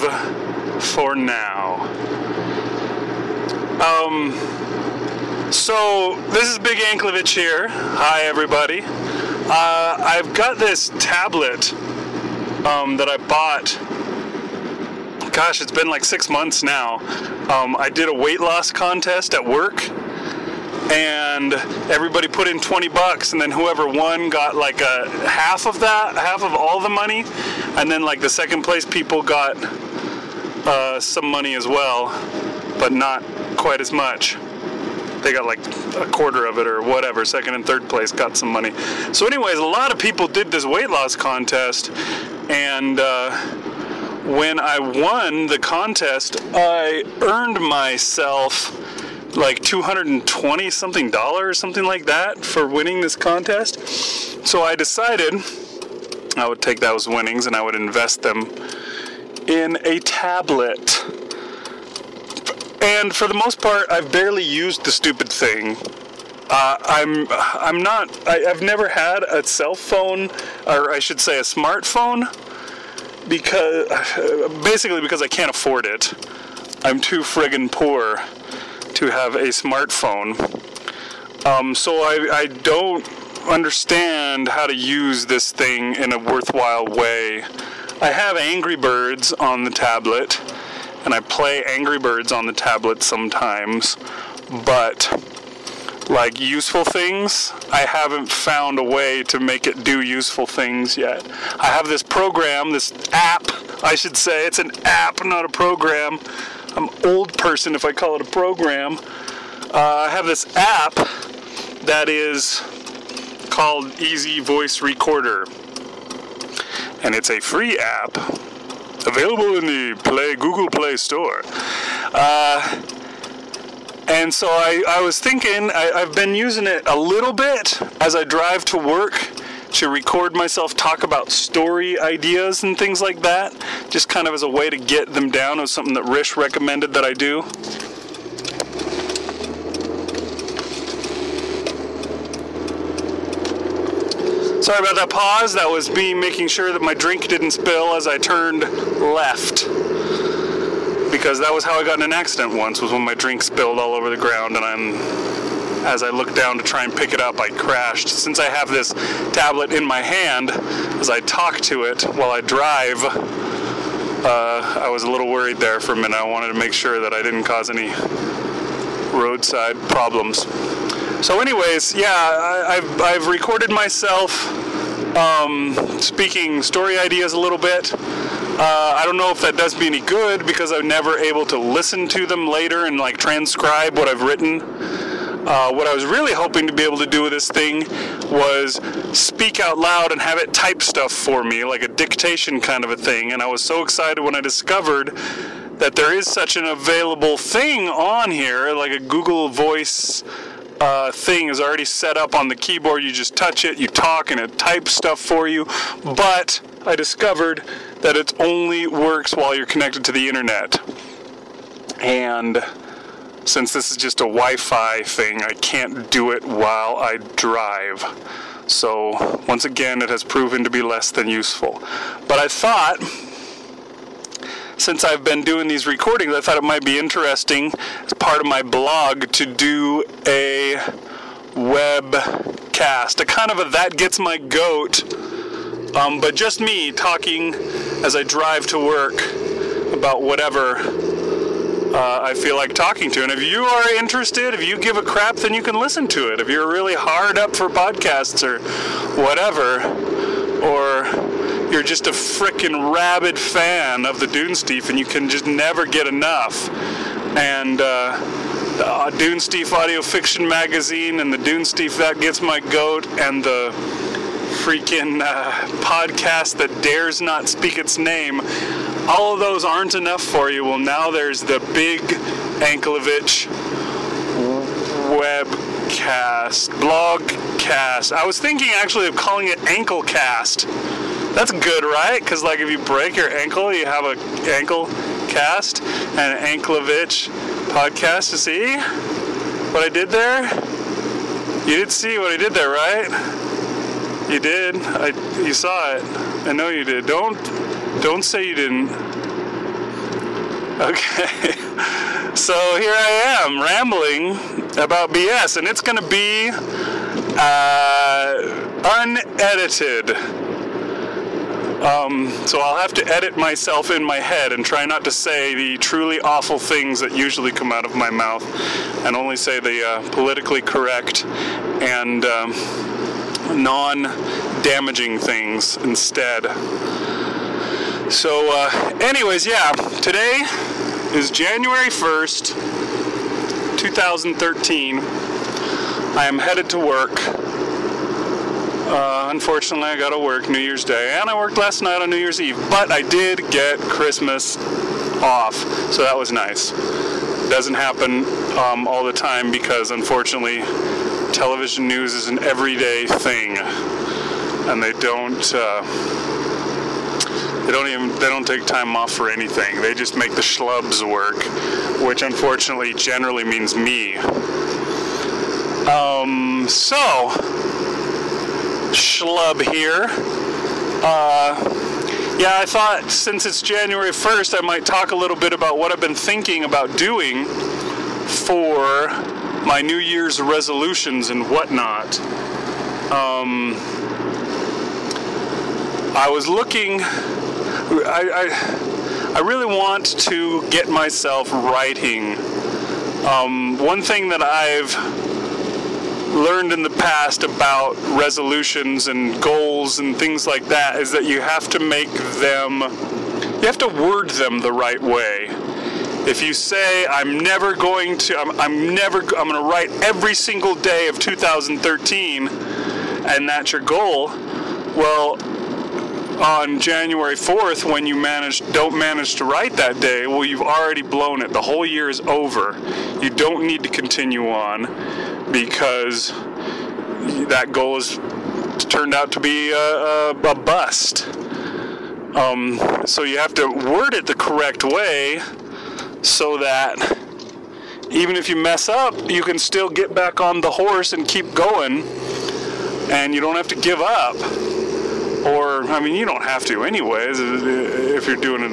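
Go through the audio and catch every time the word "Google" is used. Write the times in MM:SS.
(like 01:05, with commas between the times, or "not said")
02:00, 03:18.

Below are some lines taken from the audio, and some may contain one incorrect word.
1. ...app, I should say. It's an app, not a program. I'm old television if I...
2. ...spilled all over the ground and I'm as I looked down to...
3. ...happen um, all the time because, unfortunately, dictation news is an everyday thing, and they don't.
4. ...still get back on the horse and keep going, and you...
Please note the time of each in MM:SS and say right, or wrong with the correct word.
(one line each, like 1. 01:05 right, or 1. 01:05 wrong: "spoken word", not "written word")
1. 01:43 wrong: "person", not "television"
2. 02:33 right
3. 05:47 wrong: "television", not "dictation"
4. 07:19 right.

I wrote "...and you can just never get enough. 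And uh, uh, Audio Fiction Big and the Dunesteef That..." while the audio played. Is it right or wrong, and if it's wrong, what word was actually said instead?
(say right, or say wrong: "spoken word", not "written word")
wrong: "Magazine", not "Big".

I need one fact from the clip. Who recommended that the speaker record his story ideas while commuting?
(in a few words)
Rish.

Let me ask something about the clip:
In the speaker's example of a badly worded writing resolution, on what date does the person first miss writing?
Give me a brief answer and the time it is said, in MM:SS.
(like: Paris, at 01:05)
January 4th, at 06:56.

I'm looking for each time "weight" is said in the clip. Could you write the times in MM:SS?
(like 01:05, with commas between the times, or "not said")
00:18, 00:40.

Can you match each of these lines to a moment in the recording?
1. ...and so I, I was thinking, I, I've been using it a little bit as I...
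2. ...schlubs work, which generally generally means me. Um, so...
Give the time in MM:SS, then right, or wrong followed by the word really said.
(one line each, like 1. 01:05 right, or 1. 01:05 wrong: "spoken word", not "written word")
1. 02:04 right
2. 06:00 wrong: "unfortunately", not "generally".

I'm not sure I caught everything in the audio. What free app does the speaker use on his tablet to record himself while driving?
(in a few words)
Easy Voice Recorder.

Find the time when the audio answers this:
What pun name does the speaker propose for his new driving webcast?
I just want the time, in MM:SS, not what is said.
04:39.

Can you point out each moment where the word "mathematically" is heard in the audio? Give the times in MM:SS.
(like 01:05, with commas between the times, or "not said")
not said.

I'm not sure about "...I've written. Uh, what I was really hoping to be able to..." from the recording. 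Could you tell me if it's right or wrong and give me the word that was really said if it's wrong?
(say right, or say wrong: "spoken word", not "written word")
right.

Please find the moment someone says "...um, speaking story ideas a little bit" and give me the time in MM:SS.
02:55.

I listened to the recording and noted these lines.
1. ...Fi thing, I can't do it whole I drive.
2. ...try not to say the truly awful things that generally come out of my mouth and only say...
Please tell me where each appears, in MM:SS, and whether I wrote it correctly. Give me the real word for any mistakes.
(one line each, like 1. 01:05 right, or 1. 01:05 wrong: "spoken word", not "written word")
1. 03:34 wrong: "while", not "whole"
2. 05:14 wrong: "usually", not "generally".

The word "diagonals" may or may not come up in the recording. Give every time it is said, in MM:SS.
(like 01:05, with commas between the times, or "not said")
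not said.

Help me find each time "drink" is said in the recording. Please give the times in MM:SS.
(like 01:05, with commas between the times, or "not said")
02:26, 02:33.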